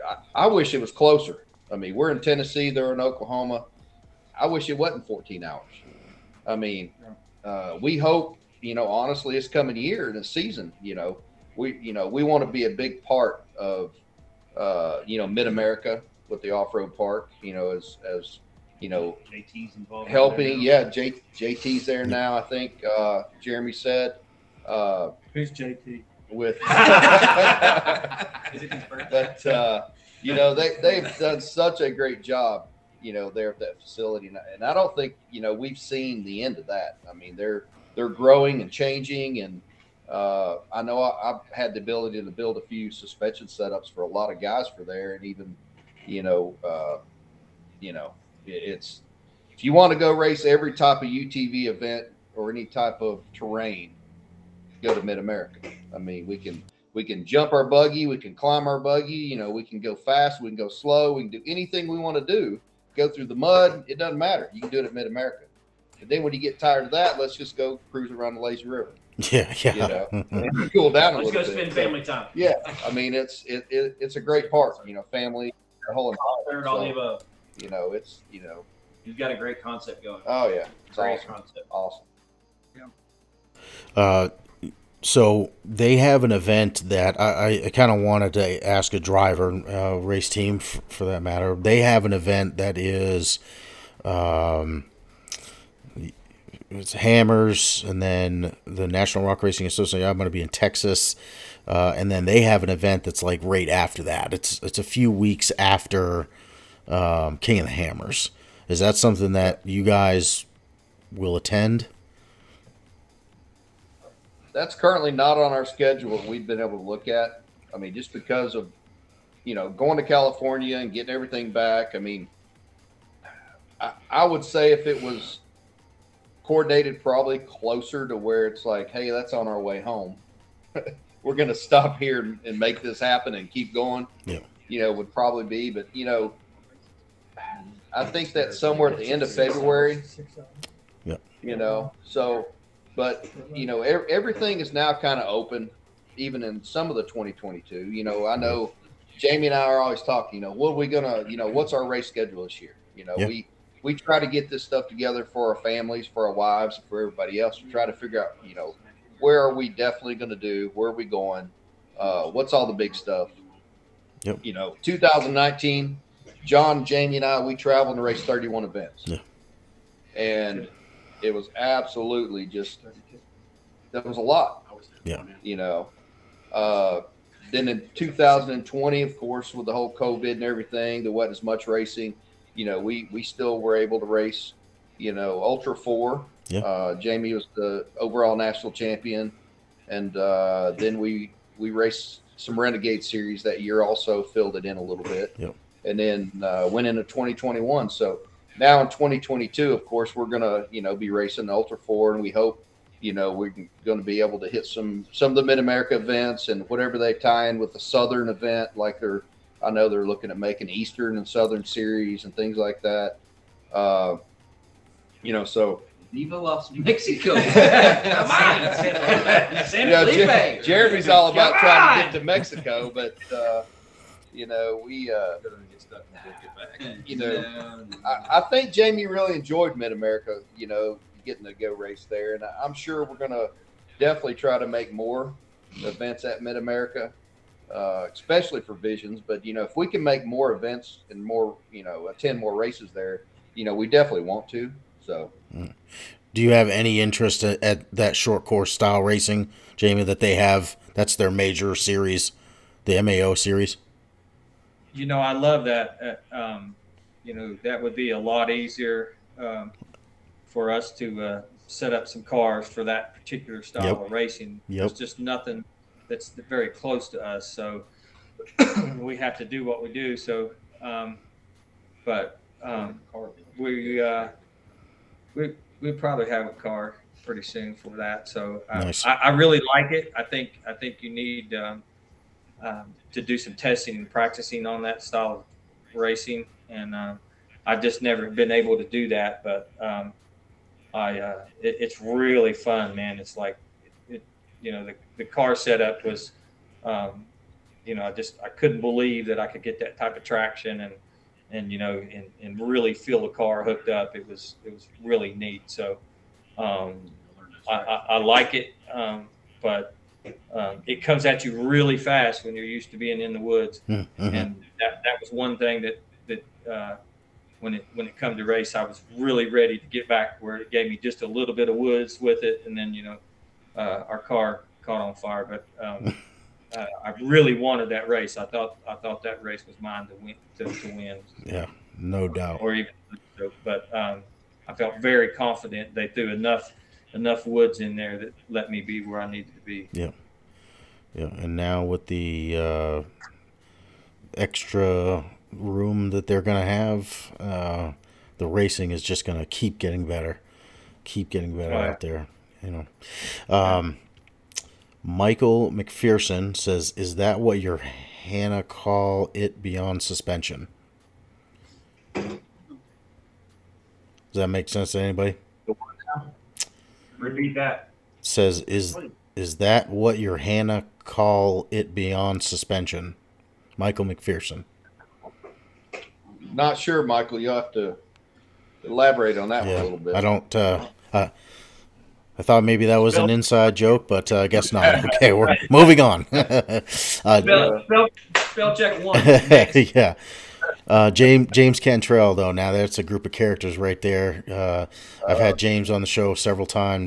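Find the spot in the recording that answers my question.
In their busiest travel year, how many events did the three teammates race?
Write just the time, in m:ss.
2:48.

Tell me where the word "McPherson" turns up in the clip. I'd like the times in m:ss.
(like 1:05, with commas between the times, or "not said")
5:55, 6:14.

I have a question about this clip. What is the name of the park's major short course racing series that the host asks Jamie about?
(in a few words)
MAO series.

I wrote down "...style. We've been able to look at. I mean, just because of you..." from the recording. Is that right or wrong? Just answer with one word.
wrong.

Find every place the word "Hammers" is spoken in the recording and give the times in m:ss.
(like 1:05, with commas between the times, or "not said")
1:36, 1:47.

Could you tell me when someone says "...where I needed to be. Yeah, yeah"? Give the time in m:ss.
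5:39.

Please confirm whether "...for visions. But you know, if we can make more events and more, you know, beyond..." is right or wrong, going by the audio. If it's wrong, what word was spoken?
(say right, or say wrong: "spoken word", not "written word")
wrong: "attend", not "beyond".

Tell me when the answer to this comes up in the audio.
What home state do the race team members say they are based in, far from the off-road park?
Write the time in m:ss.
0:02.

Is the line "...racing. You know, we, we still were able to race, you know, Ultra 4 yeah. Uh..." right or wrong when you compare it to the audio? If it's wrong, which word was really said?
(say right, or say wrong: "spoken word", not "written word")
right.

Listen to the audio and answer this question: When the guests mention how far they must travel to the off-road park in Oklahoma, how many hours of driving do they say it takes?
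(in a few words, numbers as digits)
14.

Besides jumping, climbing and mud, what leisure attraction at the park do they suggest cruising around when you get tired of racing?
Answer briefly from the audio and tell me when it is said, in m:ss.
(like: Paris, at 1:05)
Lazy River, at 1:08.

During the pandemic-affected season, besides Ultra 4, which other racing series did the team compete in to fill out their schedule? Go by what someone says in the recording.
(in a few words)
Renegade series.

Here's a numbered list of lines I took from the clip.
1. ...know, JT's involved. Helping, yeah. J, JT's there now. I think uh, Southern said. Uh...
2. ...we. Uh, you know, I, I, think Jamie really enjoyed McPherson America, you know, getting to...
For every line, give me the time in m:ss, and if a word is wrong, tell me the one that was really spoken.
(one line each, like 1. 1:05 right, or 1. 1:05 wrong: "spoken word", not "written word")
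1. 0:18 wrong: "Jeremy", not "Southern"
2. 3:44 wrong: "Mid", not "McPherson".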